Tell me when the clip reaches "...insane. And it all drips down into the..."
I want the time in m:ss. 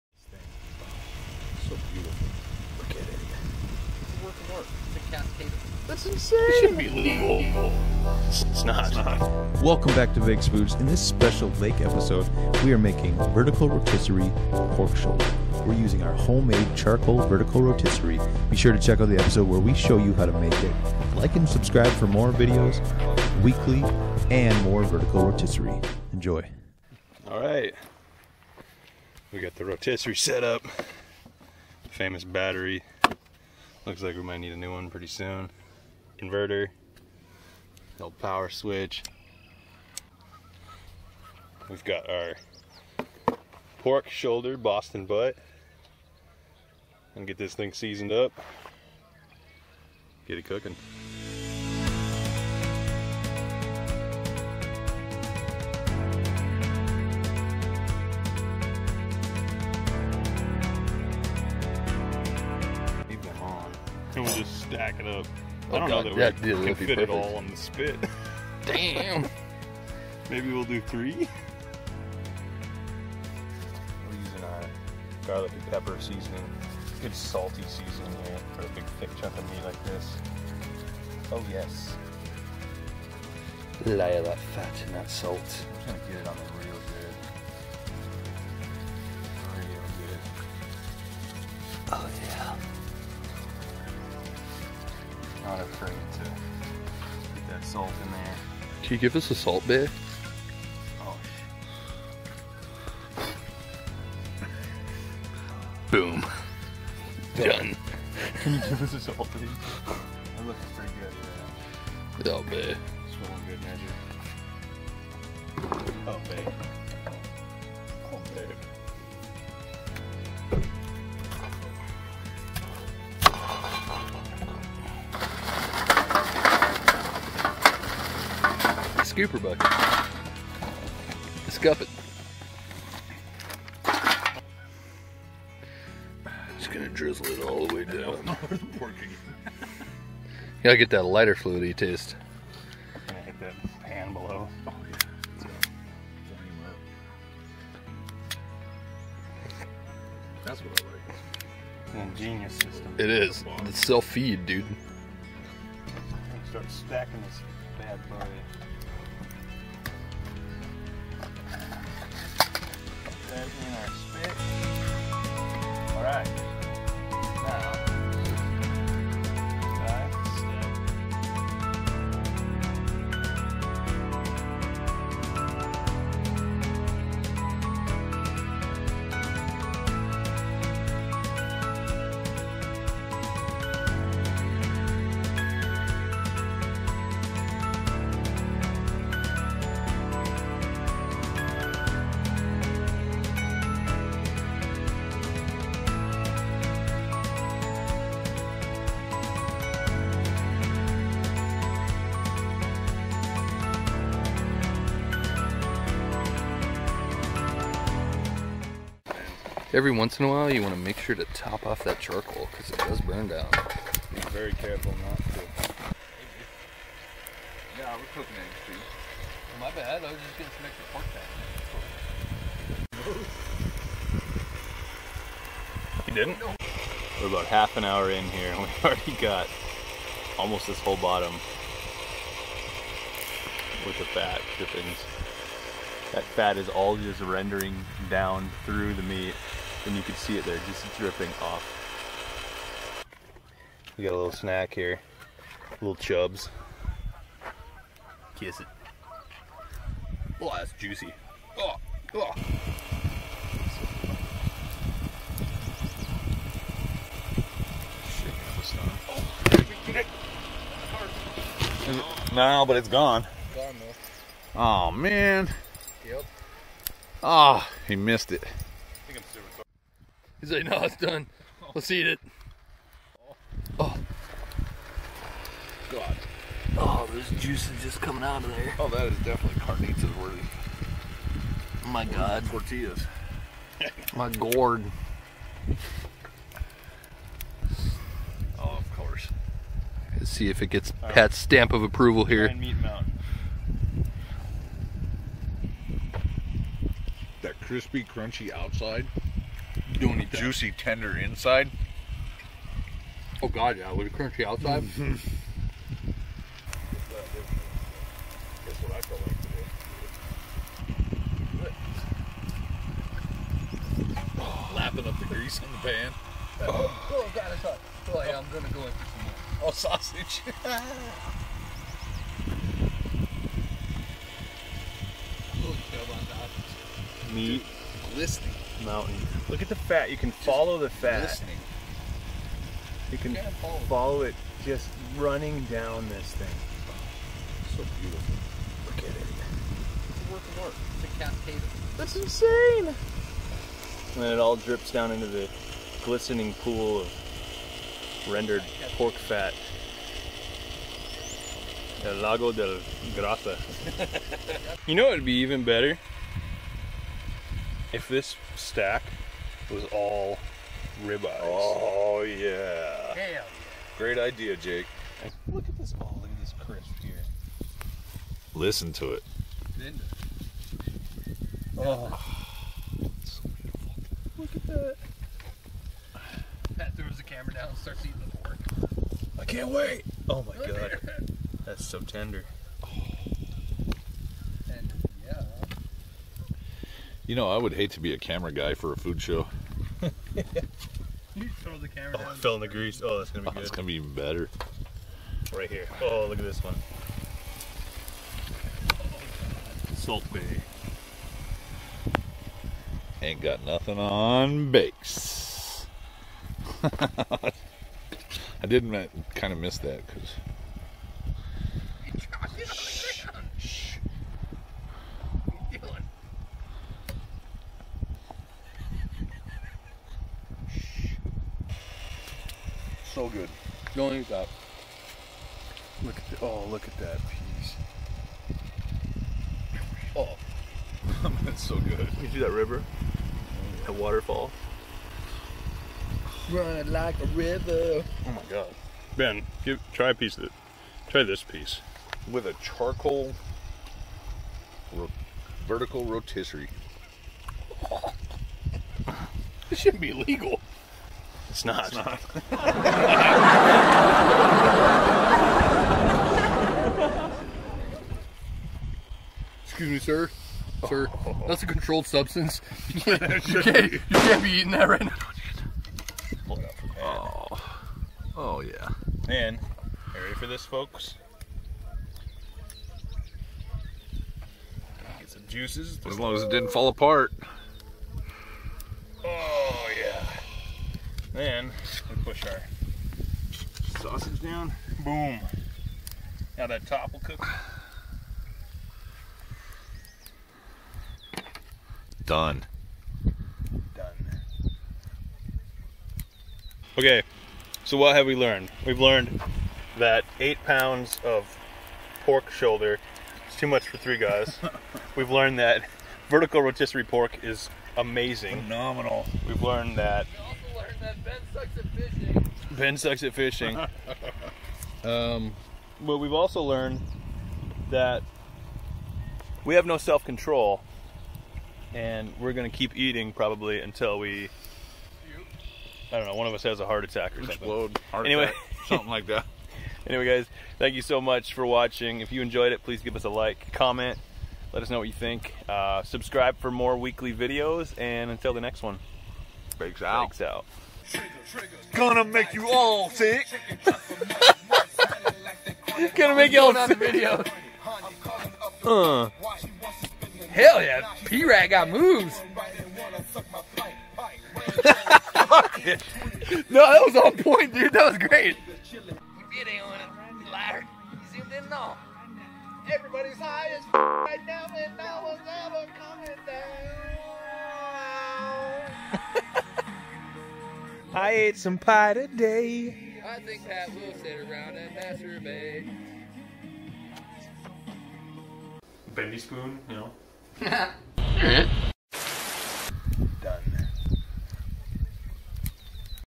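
5:42.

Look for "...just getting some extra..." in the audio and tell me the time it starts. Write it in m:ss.
3:40.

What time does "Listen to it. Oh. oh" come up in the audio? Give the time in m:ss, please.
6:08.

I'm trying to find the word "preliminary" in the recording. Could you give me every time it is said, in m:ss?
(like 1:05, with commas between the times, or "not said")
not said.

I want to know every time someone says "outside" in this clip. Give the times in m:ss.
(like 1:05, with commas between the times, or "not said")
4:58, 5:04.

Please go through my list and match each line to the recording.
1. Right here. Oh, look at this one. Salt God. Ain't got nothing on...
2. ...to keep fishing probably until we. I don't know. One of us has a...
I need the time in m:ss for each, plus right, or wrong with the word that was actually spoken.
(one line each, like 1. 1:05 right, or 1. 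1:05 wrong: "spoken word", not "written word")
1. 6:35 wrong: "Bae", not "God"
2. 8:42 wrong: "eating", not "fishing".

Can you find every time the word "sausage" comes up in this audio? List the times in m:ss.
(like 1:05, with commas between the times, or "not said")
5:19, 8:04.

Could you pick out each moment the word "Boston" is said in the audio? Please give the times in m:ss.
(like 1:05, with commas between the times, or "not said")
0:44.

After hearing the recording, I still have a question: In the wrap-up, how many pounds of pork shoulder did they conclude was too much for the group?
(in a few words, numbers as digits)
8.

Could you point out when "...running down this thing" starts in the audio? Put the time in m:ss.
5:35.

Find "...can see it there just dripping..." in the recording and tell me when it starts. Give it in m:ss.
4:00.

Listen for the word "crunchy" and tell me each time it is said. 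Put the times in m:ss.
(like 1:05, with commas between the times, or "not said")
4:58, 5:04.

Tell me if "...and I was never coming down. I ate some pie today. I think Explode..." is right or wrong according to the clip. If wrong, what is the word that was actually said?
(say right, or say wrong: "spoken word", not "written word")
wrong: "Pat", not "Explode".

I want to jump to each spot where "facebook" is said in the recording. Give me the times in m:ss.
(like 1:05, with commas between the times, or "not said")
not said.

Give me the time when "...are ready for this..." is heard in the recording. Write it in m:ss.
7:50.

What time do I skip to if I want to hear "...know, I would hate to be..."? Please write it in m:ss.
6:27.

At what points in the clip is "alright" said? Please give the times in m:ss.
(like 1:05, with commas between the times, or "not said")
not said.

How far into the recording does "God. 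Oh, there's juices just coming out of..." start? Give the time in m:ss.
4:35.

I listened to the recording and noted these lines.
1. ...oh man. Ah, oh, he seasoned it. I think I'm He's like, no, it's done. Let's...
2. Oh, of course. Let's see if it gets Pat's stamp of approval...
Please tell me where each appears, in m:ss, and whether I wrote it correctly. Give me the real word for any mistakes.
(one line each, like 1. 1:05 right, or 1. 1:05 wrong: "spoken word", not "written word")
1. 4:24 wrong: "missed", not "seasoned"
2. 4:48 right.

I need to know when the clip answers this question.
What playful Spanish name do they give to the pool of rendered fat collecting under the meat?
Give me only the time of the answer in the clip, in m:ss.
5:52.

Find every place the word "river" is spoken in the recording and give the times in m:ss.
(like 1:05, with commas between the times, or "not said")
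7:12, 7:17.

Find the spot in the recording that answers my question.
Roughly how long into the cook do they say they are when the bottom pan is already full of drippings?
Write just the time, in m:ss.
3:47.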